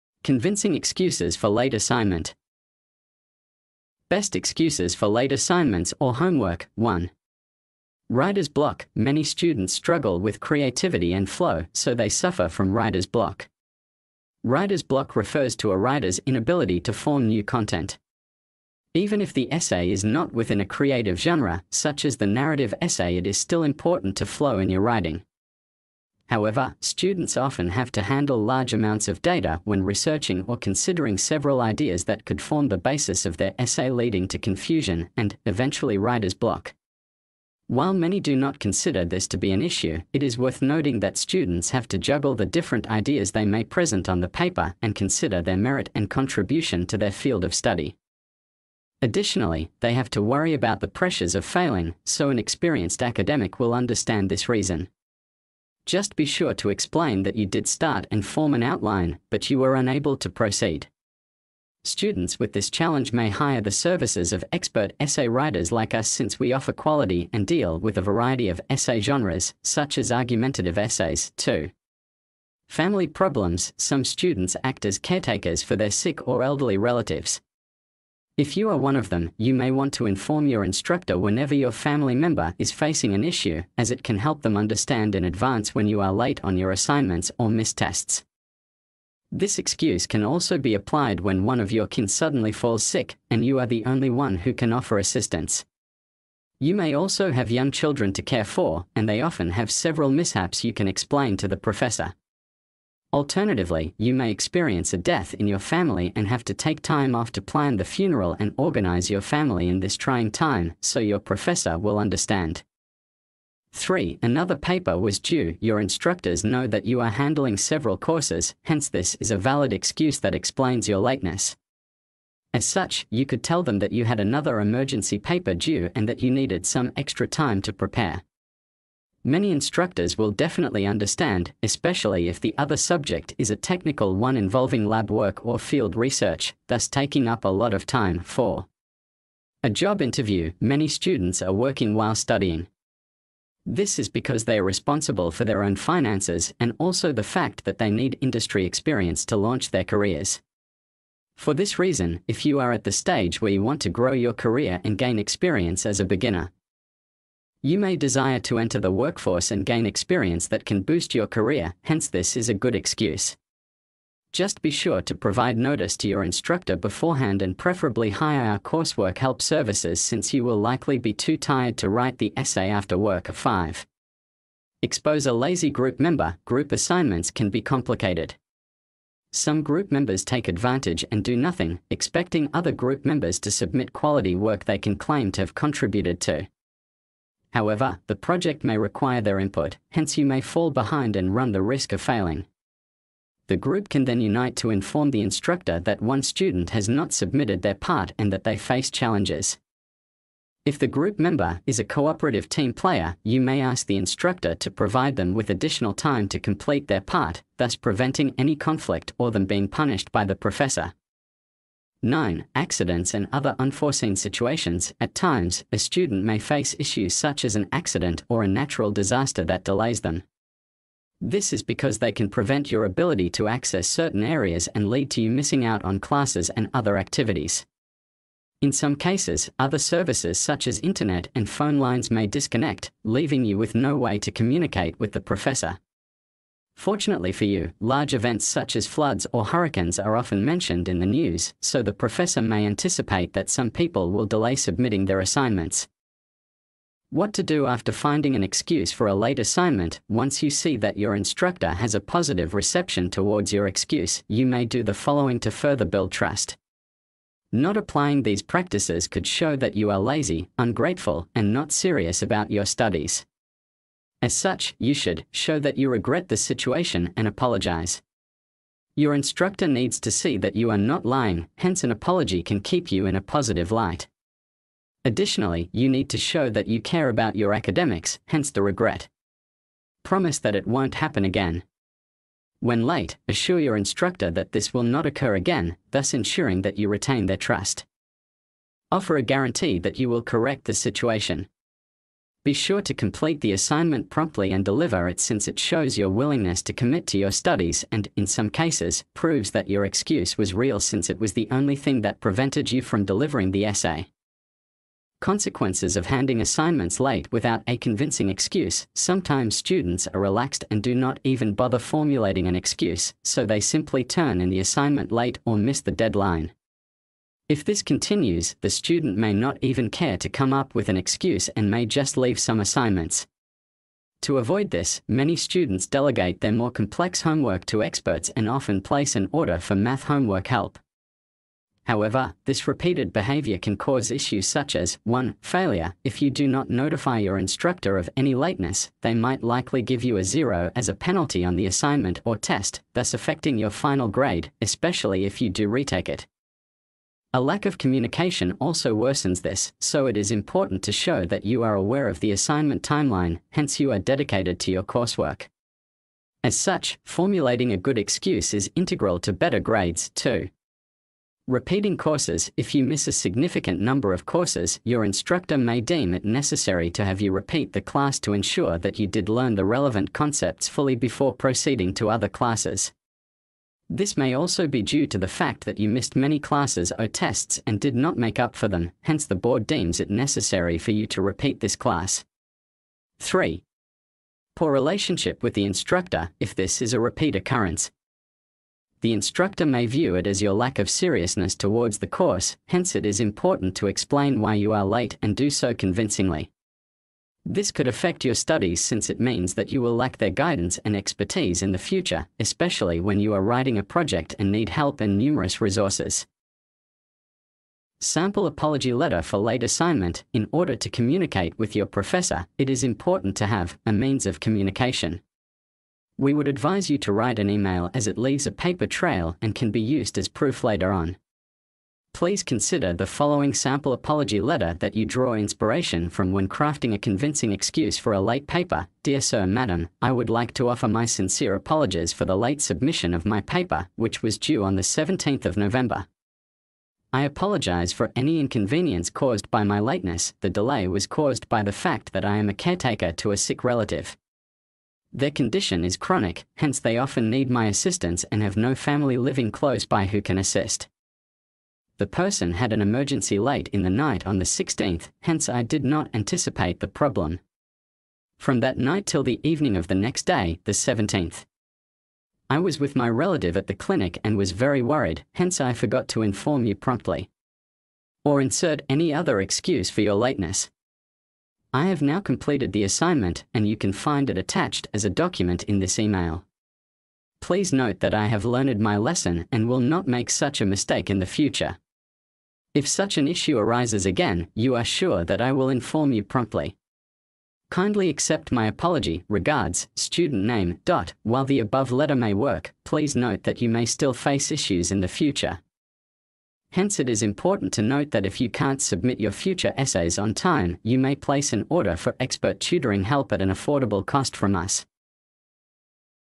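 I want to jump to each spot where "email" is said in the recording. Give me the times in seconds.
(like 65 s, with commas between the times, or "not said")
417 s, 475 s.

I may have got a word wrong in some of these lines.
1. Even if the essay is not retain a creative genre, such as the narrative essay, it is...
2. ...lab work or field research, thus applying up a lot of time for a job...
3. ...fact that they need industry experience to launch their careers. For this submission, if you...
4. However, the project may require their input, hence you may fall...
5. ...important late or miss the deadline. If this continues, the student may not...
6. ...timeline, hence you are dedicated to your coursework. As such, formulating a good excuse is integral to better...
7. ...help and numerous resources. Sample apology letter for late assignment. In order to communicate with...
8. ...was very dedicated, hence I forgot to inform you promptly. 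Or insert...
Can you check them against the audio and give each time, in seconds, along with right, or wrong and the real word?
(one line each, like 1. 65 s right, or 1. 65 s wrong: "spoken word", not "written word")
1. 18 s wrong: "within", not "retain"
2. 134 s wrong: "taking", not "applying"
3. 147 s wrong: "reason", not "submission"
4. 187 s right
5. 314 s wrong: "assignment", not "important"
6. 352 s right
7. 404 s right
8. 464 s wrong: "worried", not "dedicated".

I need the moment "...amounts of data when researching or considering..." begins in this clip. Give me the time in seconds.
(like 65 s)
28 s.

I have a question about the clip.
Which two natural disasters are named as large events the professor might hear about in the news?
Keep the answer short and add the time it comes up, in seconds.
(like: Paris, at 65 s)
Floods or hurricanes, at 238 s.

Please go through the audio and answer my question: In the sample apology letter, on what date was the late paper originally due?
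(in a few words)
17th of November.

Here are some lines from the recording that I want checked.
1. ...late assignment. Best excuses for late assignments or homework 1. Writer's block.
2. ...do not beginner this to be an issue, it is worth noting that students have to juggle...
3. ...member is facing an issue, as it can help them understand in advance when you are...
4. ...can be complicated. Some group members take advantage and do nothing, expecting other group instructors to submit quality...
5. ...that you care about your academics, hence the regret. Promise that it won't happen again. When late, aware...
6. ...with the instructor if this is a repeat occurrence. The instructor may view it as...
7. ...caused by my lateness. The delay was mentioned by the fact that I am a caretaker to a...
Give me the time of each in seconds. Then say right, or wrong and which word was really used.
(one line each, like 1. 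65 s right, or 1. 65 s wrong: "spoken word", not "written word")
1. 1 s right
2. 38 s wrong: "consider", not "beginner"
3. 82 s right
4. 177 s wrong: "members", not "instructors"
5. 276 s wrong: "assure", not "aware"
6. 385 s right
7. 439 s wrong: "caused", not "mentioned".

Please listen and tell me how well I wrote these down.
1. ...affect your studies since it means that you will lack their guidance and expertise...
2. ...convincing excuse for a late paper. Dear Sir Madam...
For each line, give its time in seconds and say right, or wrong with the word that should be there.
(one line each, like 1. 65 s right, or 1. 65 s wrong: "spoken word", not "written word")
1. 397 s right
2. 426 s right.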